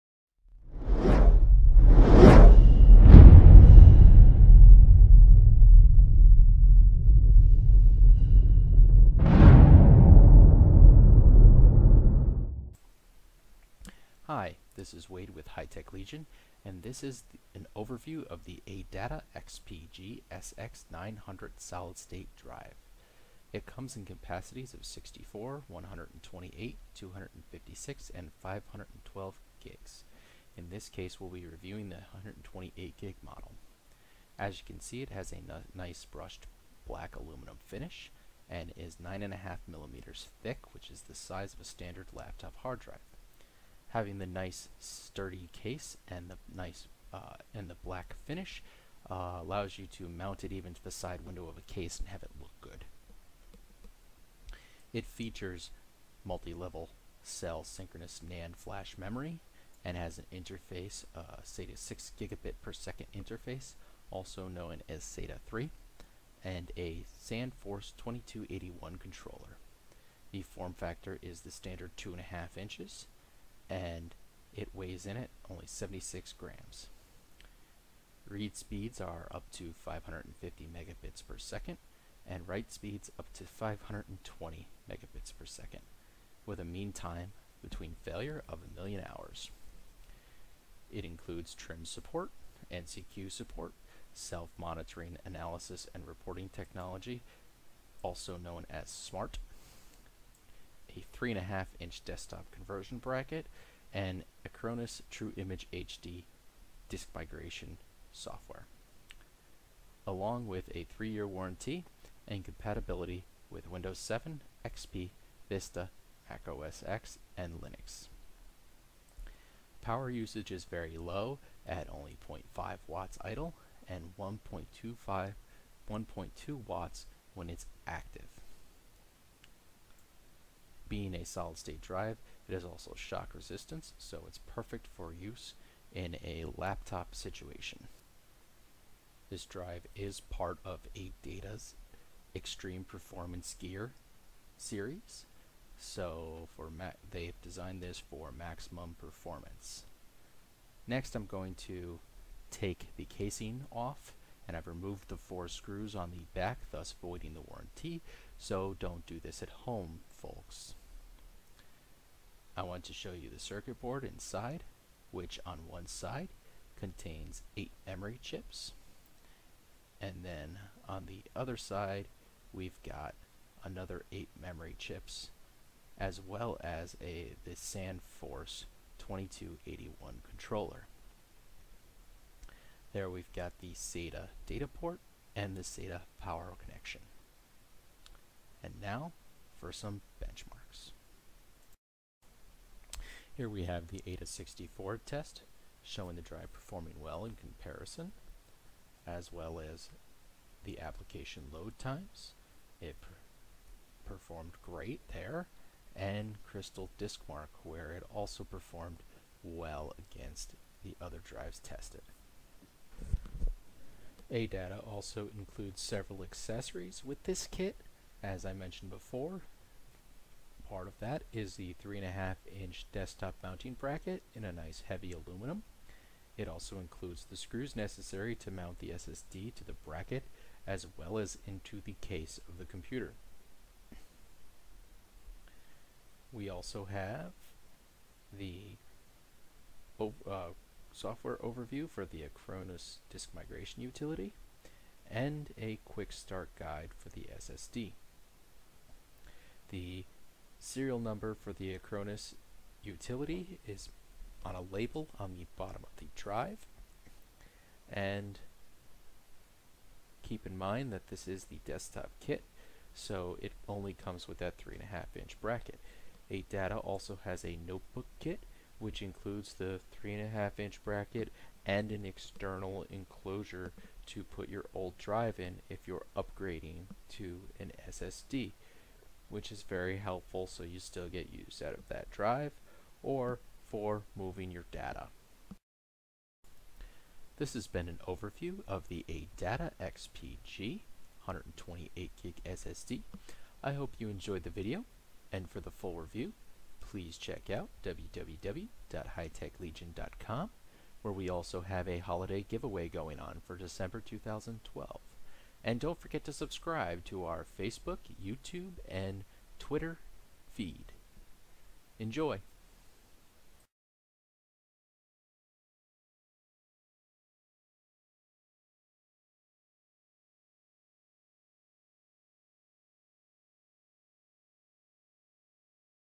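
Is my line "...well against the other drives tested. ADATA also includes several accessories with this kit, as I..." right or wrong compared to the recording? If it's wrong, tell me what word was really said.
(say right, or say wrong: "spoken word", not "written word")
right.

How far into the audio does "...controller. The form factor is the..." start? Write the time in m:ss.
1:08.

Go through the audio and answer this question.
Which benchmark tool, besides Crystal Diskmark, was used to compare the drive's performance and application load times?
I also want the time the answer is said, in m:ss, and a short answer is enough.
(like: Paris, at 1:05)
AIDA 64, at 3:14.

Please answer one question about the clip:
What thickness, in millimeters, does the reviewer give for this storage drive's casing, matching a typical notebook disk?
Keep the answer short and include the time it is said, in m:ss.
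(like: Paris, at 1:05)
9.5 millimeters, at 0:38.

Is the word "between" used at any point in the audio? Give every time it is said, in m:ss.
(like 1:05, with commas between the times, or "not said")
1:27.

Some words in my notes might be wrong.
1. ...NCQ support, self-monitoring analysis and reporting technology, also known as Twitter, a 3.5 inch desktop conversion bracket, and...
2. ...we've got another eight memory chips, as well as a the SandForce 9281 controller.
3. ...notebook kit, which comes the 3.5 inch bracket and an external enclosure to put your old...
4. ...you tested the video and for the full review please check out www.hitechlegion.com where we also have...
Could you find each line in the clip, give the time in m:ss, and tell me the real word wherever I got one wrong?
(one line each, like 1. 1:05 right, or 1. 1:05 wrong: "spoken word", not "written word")
1. 1:32 wrong: "SMART", not "Twitter"
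2. 2:52 wrong: "2281", not "9281"
3. 4:27 wrong: "includes", not "comes"
4. 4:53 wrong: "enjoyed", not "tested".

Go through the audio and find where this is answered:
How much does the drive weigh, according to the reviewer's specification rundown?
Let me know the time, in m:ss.
1:15.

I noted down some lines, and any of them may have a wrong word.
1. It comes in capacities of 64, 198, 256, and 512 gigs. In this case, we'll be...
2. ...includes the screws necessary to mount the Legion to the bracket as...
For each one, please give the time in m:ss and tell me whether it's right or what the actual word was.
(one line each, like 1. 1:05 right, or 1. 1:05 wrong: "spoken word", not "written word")
1. 0:23 wrong: "128", not "198"
2. 3:46 wrong: "SSD", not "Legion".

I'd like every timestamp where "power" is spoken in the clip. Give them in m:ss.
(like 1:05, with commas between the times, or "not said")
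1:59, 3:06.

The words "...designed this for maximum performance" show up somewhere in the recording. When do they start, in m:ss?
2:27.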